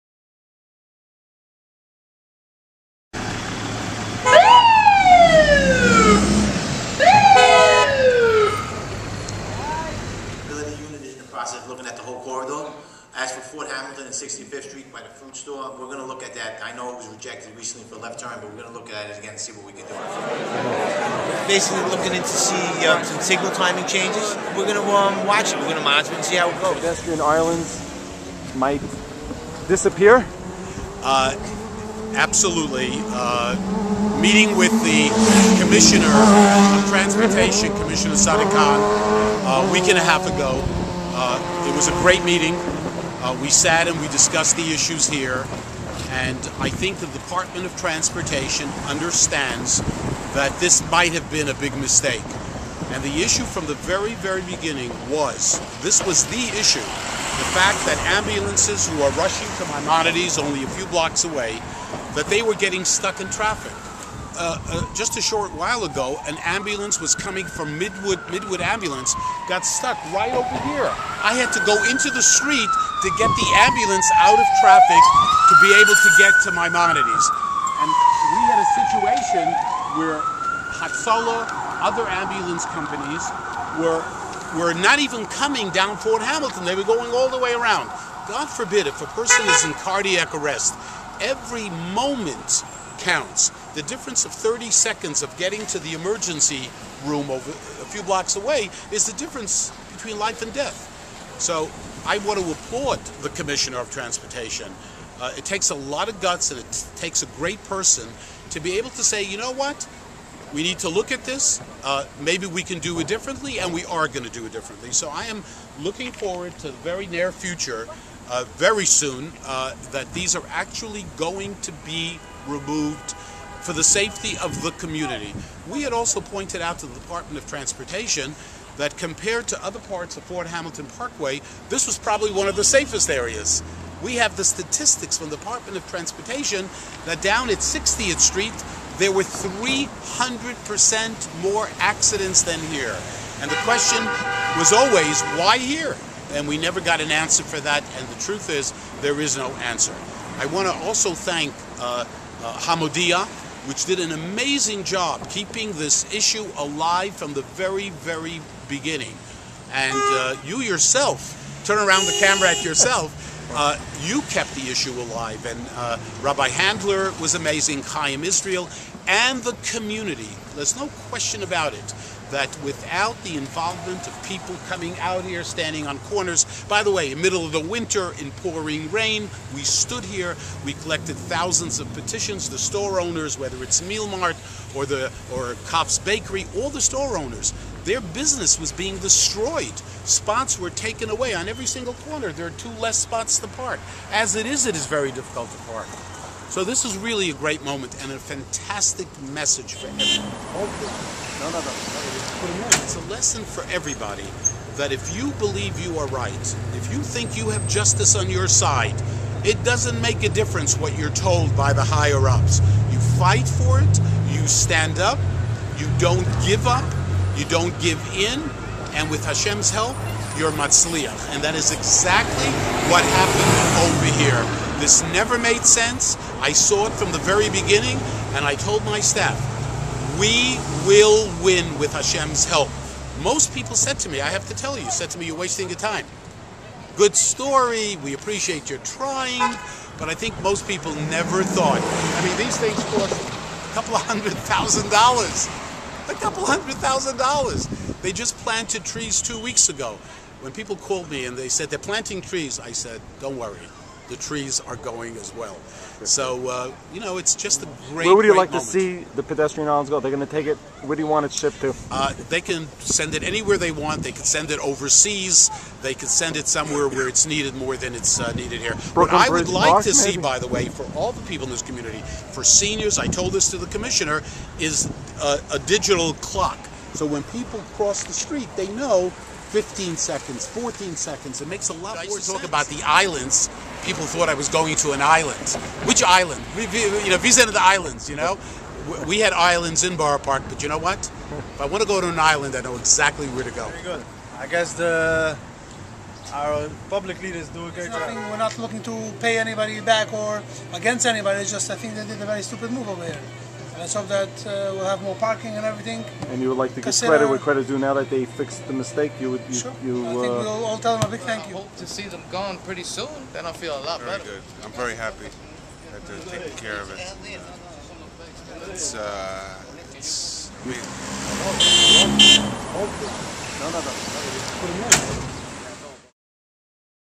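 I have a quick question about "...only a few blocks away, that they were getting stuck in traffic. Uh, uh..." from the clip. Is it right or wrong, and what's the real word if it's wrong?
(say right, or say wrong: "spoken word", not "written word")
right.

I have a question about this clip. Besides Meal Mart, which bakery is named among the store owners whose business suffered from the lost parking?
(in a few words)
Cops Bakery.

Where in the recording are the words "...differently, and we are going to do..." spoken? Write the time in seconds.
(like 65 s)
113 s.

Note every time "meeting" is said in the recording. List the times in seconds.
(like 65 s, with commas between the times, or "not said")
34 s, 42 s.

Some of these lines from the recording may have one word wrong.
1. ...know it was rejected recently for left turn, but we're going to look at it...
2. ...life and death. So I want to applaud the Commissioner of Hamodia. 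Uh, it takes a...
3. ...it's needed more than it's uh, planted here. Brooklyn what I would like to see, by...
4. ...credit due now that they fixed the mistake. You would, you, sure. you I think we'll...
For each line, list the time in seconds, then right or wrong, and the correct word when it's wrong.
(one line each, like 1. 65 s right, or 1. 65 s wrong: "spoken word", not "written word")
1. 16 s right
2. 100 s wrong: "Transportation", not "Hamodia"
3. 267 s wrong: "needed", not "planted"
4. 307 s right.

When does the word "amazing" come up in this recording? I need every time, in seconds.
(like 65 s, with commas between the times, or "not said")
154 s, 167 s.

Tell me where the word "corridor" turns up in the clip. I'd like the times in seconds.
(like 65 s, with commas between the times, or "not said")
12 s.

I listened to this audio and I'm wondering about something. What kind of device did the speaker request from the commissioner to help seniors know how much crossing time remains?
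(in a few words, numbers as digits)
A digital clock.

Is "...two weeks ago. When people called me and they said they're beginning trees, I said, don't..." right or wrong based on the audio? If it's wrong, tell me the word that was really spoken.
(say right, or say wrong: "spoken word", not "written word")
wrong: "planting", not "beginning".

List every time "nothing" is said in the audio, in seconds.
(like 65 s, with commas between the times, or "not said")
297 s.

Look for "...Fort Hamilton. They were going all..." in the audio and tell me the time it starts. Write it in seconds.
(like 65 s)
86 s.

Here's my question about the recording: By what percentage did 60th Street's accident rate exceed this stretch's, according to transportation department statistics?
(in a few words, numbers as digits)
300%.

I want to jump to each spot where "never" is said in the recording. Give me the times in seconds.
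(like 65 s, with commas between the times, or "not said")
146 s, 225 s, 241 s.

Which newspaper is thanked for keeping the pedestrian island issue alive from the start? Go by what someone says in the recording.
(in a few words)
Hamodia.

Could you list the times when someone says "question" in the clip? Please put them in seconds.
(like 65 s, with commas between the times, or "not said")
143 s, 171 s.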